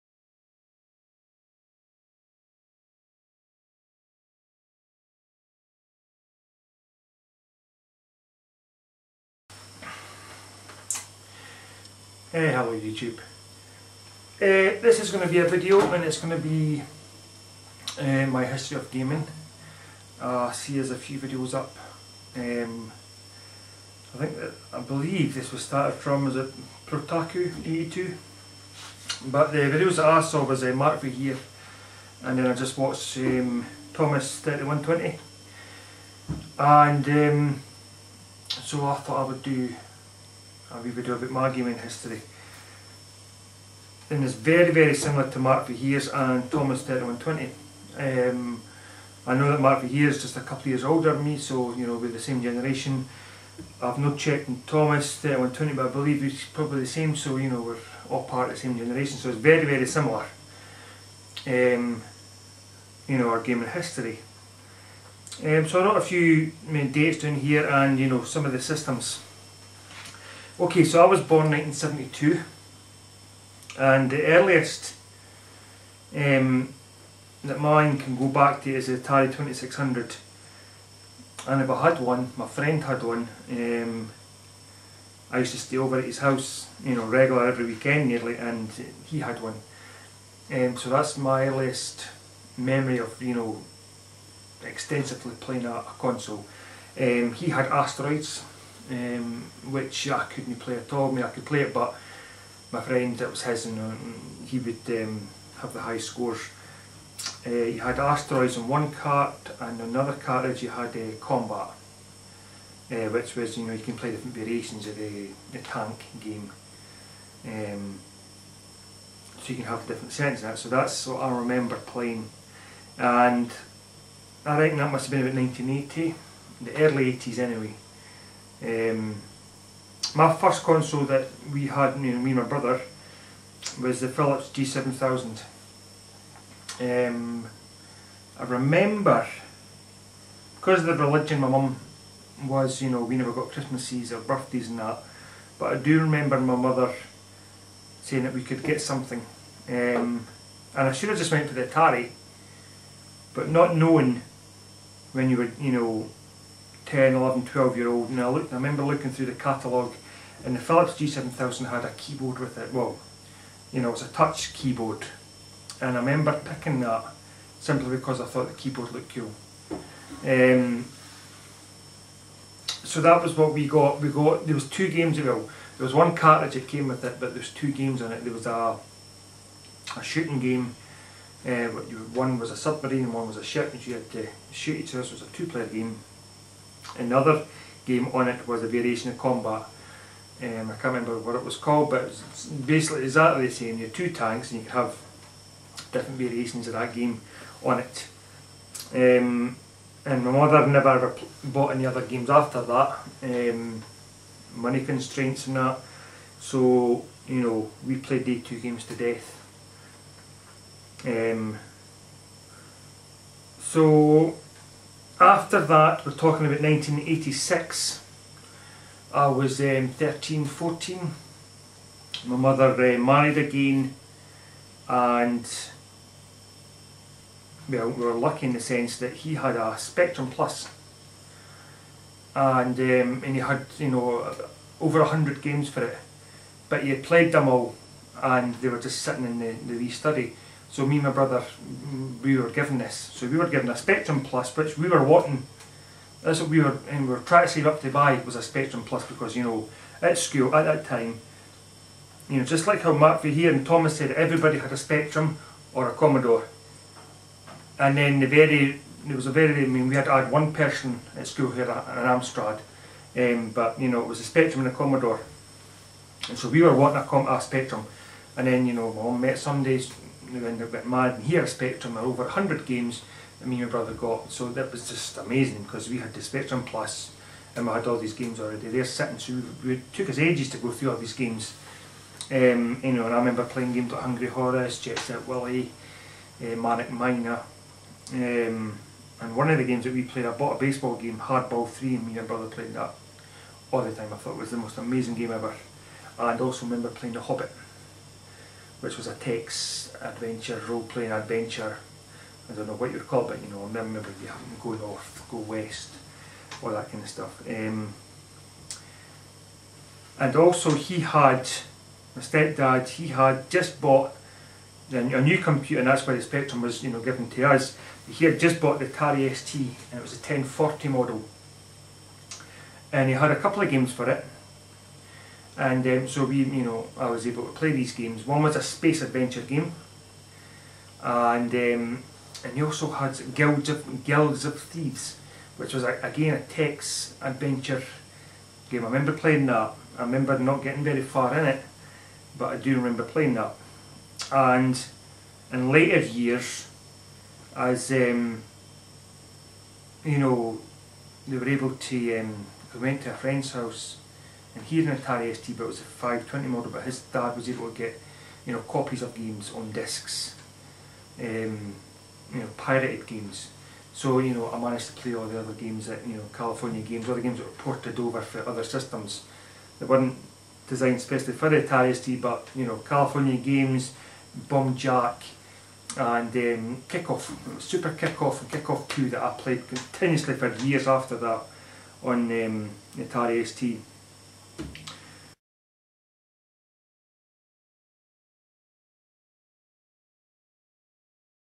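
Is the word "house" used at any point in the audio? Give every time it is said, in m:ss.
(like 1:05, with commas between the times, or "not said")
1:26, 5:53.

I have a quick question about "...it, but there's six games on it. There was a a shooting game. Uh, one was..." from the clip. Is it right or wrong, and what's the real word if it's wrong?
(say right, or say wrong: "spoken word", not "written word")
wrong: "two", not "six".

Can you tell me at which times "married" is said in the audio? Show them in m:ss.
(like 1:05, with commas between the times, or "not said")
3:42.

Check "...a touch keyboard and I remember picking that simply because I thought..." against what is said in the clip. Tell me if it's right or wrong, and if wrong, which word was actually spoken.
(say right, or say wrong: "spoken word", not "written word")
right.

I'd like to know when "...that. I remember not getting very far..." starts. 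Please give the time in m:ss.
5:39.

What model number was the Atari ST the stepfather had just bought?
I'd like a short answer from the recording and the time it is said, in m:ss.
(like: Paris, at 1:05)
1040, at 5:20.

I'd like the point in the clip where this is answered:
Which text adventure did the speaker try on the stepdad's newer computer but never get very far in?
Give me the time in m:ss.
5:34.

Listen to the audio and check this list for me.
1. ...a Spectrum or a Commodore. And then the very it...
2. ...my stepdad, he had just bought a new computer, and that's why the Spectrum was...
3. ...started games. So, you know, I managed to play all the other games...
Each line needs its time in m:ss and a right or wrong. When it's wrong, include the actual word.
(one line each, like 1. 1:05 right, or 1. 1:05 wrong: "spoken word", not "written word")
1. 4:14 right
2. 5:12 right
3. 6:02 wrong: "pirated", not "started".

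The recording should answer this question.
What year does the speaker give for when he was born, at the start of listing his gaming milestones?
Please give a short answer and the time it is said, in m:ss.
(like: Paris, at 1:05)
1972, at 1:11.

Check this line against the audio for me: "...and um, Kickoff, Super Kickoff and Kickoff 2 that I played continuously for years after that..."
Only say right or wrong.
right.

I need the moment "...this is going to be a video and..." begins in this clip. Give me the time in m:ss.
0:14.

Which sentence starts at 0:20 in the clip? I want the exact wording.
Uh, I see there's a few videos up.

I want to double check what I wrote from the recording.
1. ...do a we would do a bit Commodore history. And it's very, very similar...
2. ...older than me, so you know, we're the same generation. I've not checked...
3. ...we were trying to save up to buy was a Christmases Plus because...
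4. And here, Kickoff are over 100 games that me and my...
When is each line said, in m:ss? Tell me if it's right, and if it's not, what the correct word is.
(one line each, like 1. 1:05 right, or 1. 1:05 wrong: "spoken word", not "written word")
1. 0:39 wrong: "Maggie", not "Commodore"
2. 0:50 right
3. 4:07 wrong: "Spectrum", not "Christmases"
4. 4:31 wrong: "Spectrum", not "Kickoff".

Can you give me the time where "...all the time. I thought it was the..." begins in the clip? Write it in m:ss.
4:53.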